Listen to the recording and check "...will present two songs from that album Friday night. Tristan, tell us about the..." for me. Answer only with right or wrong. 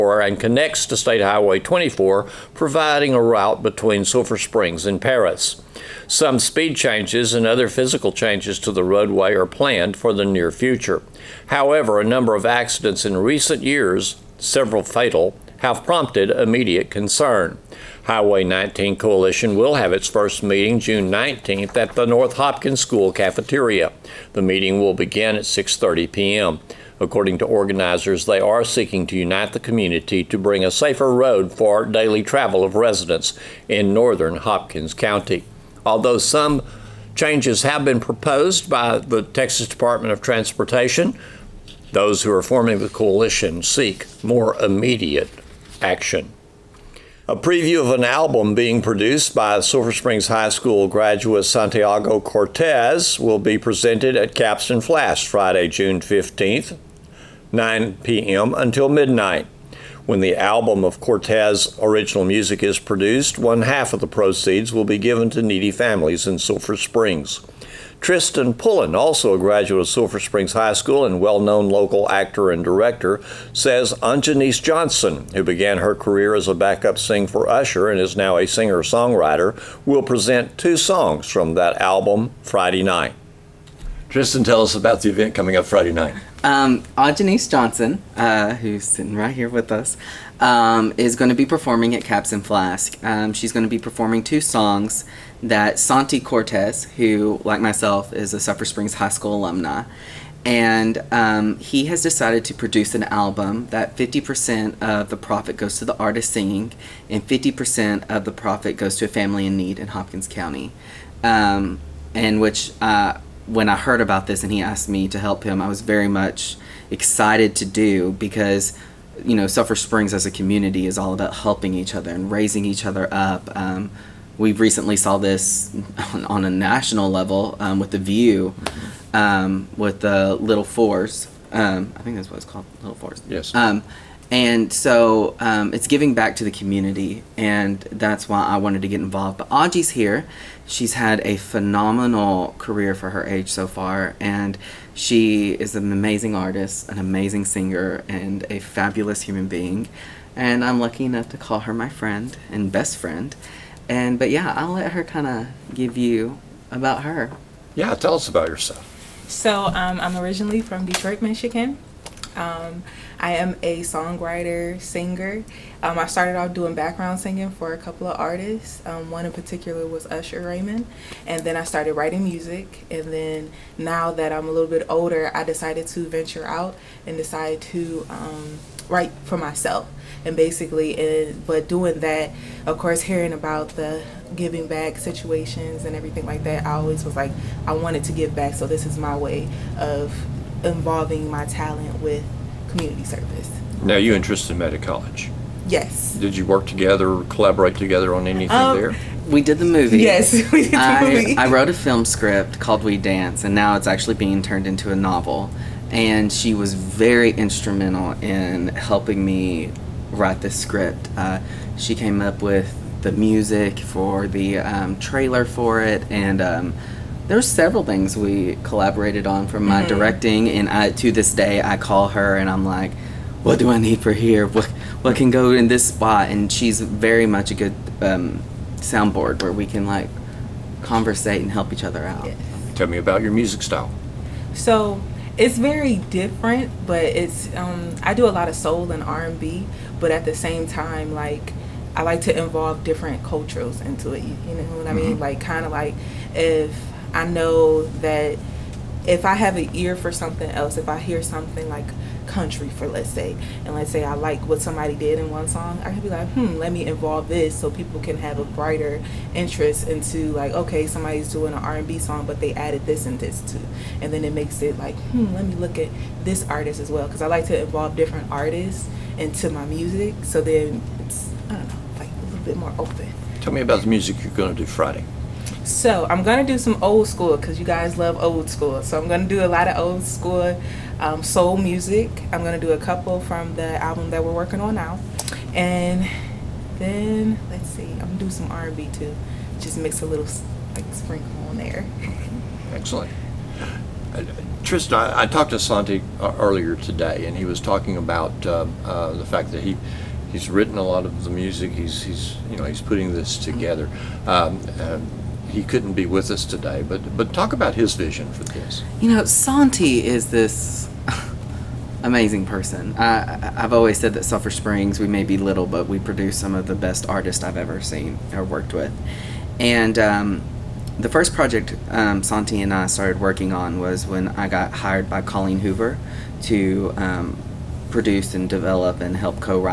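right.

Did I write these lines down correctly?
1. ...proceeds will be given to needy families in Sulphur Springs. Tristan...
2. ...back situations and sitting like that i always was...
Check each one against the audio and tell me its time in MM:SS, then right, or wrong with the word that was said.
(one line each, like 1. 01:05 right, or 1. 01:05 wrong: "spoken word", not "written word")
1. 01:04 right
2. 03:04 wrong: "everything", not "sitting".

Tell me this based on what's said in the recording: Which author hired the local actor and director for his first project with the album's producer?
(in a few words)
Colleen Hoover.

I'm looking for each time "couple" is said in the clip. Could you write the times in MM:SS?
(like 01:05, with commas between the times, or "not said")
02:47, 04:42.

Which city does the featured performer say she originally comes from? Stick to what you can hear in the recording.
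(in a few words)
Detroit, Michigan.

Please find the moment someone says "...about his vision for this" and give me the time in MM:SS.
05:07.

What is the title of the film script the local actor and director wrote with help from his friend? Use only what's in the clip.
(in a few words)
We Dance.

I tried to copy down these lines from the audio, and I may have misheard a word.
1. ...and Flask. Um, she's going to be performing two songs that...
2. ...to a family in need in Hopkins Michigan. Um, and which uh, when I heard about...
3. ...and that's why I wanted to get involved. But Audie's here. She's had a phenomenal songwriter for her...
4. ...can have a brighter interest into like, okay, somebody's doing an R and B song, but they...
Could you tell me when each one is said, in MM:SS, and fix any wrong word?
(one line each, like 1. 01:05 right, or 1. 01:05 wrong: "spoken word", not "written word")
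1. 01:32 right
2. 01:48 wrong: "County", not "Michigan"
3. 02:17 wrong: "career", not "songwriter"
4. 04:17 right.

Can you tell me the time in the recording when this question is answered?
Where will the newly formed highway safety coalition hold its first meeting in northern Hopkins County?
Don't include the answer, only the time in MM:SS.
00:22.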